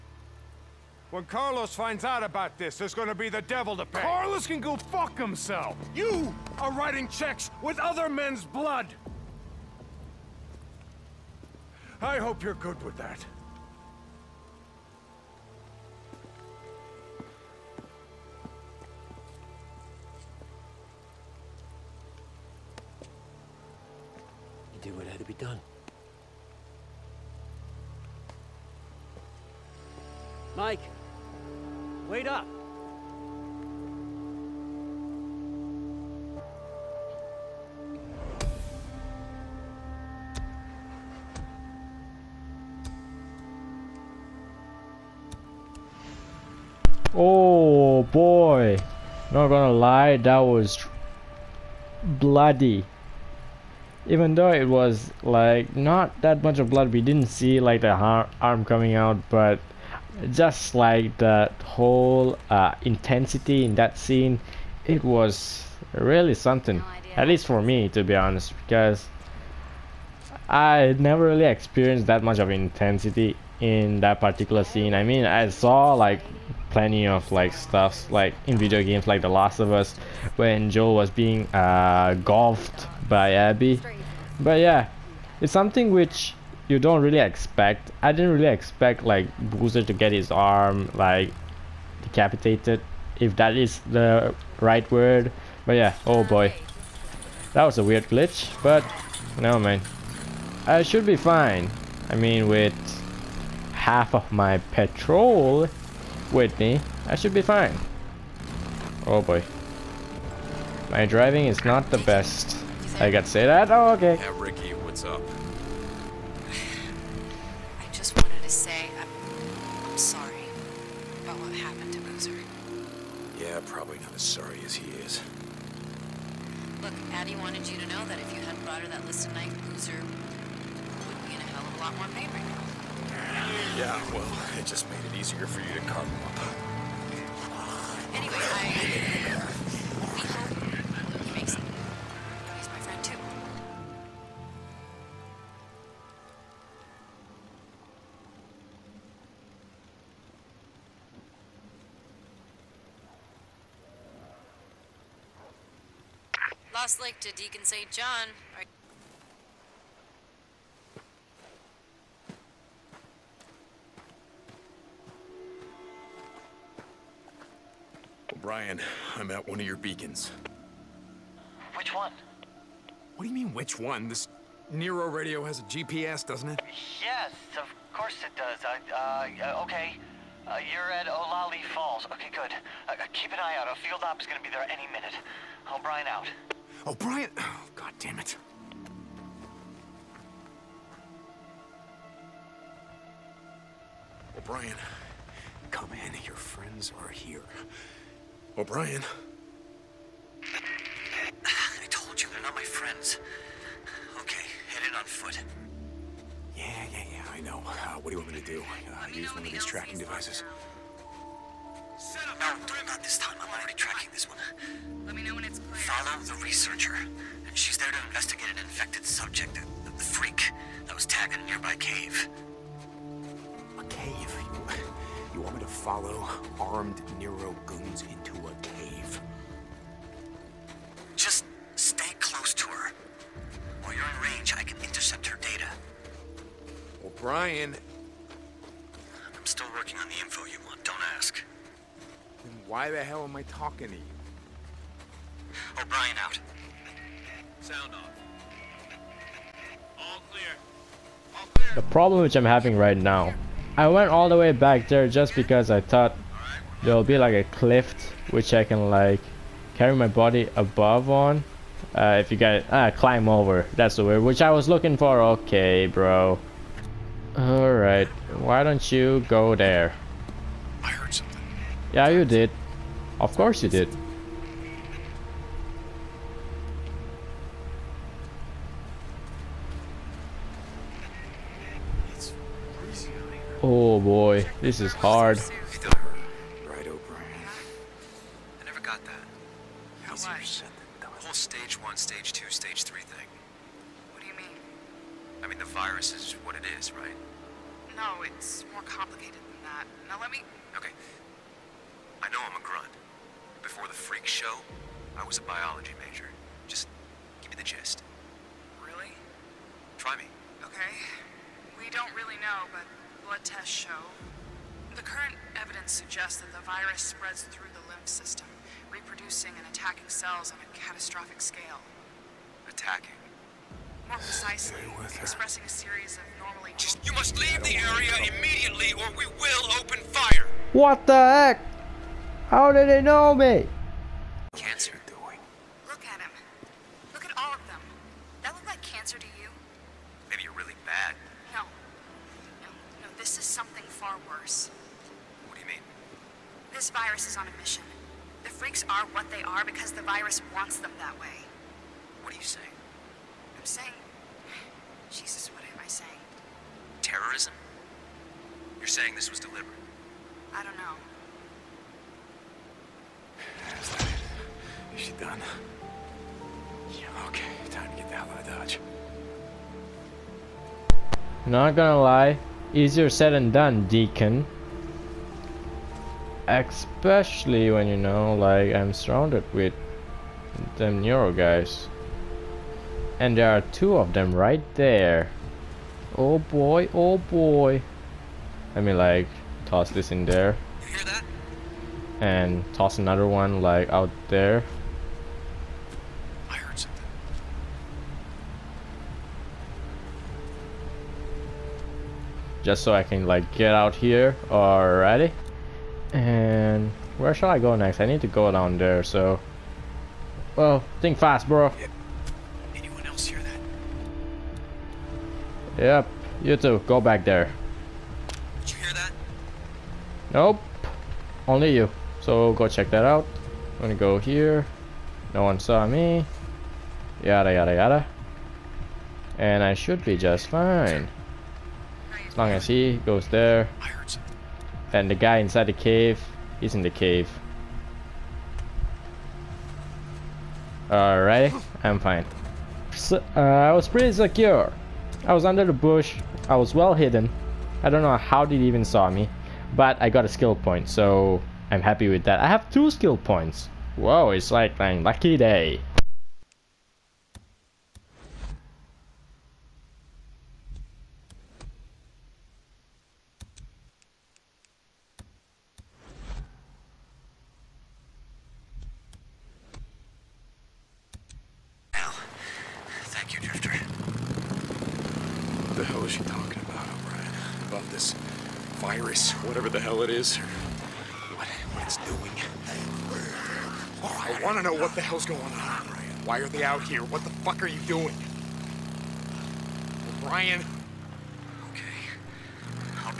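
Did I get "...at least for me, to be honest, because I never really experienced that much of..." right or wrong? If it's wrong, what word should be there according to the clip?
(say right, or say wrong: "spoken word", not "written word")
right.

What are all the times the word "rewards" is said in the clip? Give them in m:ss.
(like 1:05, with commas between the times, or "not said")
not said.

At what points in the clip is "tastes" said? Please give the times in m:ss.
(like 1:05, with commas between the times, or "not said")
not said.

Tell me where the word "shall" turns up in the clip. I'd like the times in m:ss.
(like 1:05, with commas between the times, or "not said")
6:47.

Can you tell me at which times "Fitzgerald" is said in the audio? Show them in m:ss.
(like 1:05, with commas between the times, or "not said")
not said.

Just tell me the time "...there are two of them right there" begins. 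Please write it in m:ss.
6:23.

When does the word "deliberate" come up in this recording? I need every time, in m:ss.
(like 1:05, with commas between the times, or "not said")
5:59.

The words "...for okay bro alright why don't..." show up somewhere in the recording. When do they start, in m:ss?
4:24.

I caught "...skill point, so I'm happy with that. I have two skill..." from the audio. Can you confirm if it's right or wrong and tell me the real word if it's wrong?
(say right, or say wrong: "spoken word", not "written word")
right.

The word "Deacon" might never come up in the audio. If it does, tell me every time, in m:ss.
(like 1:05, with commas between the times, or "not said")
2:37, 6:13.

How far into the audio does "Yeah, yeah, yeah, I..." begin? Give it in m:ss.
3:26.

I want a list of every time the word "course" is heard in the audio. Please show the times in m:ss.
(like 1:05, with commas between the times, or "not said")
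2:57, 4:33.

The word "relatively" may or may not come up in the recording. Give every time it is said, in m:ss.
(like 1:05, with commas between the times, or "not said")
not said.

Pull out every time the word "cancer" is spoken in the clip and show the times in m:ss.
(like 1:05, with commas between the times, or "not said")
5:34, 5:38.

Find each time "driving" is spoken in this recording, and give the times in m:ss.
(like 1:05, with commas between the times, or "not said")
1:51.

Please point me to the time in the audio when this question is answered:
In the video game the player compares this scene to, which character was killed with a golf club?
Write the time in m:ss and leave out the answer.
1:20.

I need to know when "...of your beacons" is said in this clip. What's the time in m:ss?
2:49.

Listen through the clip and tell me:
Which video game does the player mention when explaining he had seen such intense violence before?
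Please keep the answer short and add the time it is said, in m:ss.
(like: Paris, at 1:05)
The Last of Us, at 1:19.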